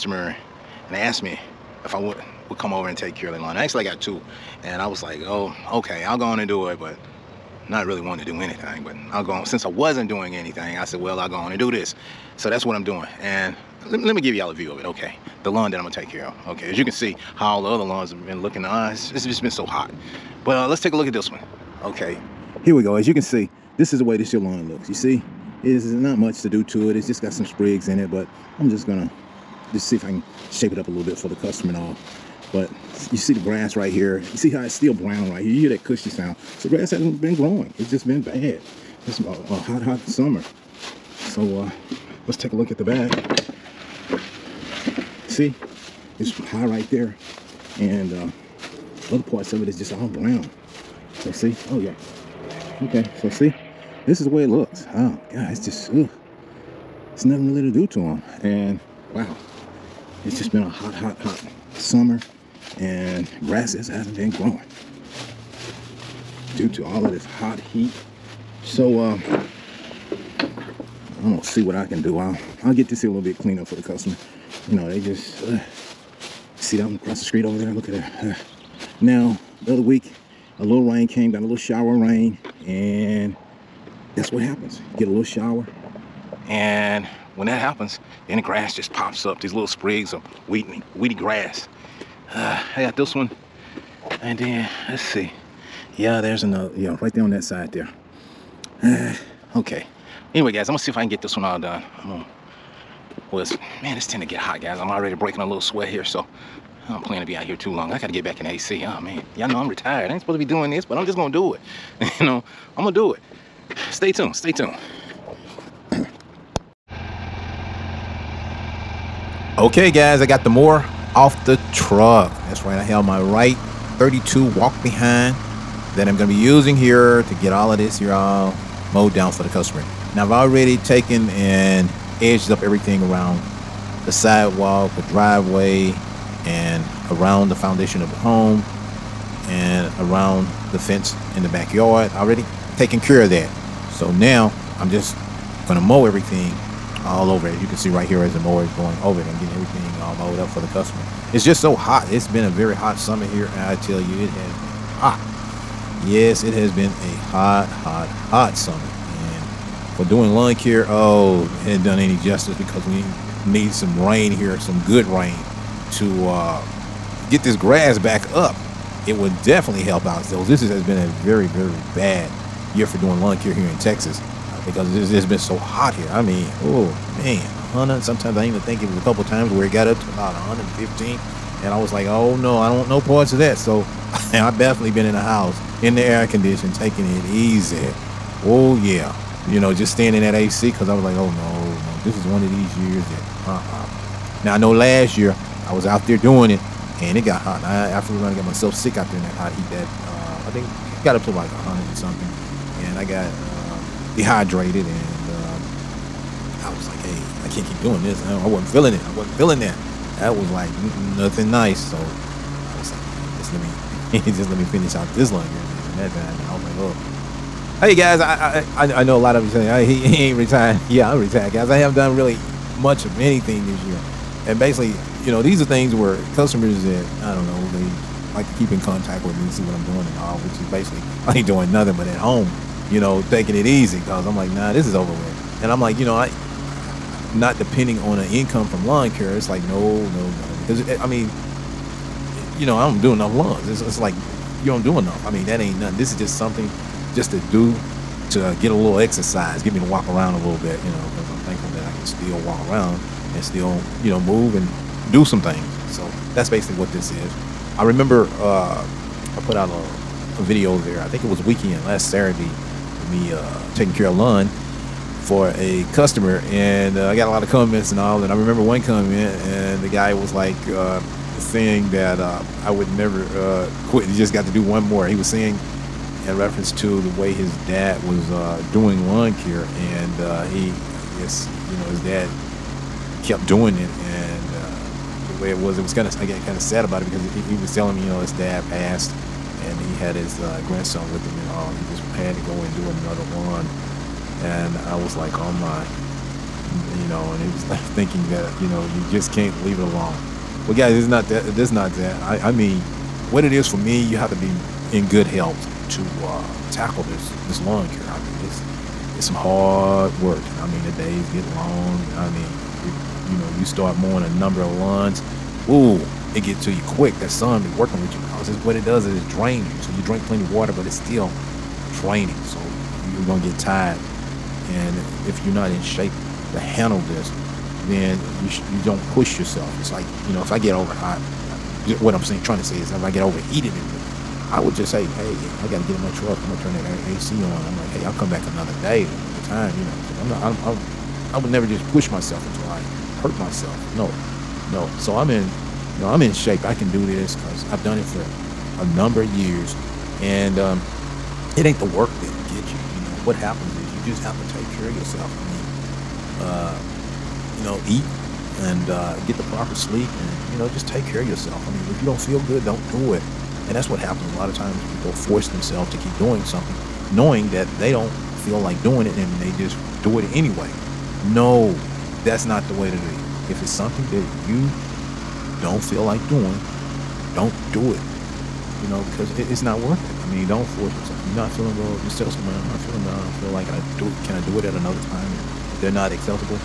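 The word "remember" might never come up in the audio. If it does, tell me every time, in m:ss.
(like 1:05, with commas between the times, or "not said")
4:17, 4:28.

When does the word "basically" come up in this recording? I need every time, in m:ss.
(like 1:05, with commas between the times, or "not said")
3:44, 3:50, 4:16.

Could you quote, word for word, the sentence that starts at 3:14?
Now I know last year I was out there doing it and it got hot.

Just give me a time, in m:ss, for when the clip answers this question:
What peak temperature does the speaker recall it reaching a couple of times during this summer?
3:00.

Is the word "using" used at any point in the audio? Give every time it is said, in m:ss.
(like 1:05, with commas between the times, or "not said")
2:06.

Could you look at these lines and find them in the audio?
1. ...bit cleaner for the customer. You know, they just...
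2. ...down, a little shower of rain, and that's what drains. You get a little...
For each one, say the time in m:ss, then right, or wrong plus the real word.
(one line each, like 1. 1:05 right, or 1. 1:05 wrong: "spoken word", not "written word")
1. 1:13 right
2. 1:21 wrong: "happens", not "drains".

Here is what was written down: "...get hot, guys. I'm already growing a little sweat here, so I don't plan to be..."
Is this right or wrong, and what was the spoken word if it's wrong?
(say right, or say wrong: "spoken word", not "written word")
wrong: "breaking", not "growing".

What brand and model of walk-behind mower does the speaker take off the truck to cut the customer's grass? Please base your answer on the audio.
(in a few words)
Wright 32.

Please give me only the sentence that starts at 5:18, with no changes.
Cause it's, what it does is it drains you.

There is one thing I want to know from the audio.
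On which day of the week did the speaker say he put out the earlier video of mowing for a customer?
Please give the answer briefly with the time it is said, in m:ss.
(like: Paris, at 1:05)
Saturday, at 4:22.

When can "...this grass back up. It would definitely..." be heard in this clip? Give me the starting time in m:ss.
2:47.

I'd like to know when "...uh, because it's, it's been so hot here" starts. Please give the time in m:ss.
2:54.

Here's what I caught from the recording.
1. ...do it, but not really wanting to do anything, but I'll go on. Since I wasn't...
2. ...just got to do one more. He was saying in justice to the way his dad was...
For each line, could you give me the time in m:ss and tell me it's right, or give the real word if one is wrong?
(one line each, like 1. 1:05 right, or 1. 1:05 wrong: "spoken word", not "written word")
1. 0:06 right
2. 4:34 wrong: "reference", not "justice".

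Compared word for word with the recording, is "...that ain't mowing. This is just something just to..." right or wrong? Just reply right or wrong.
wrong.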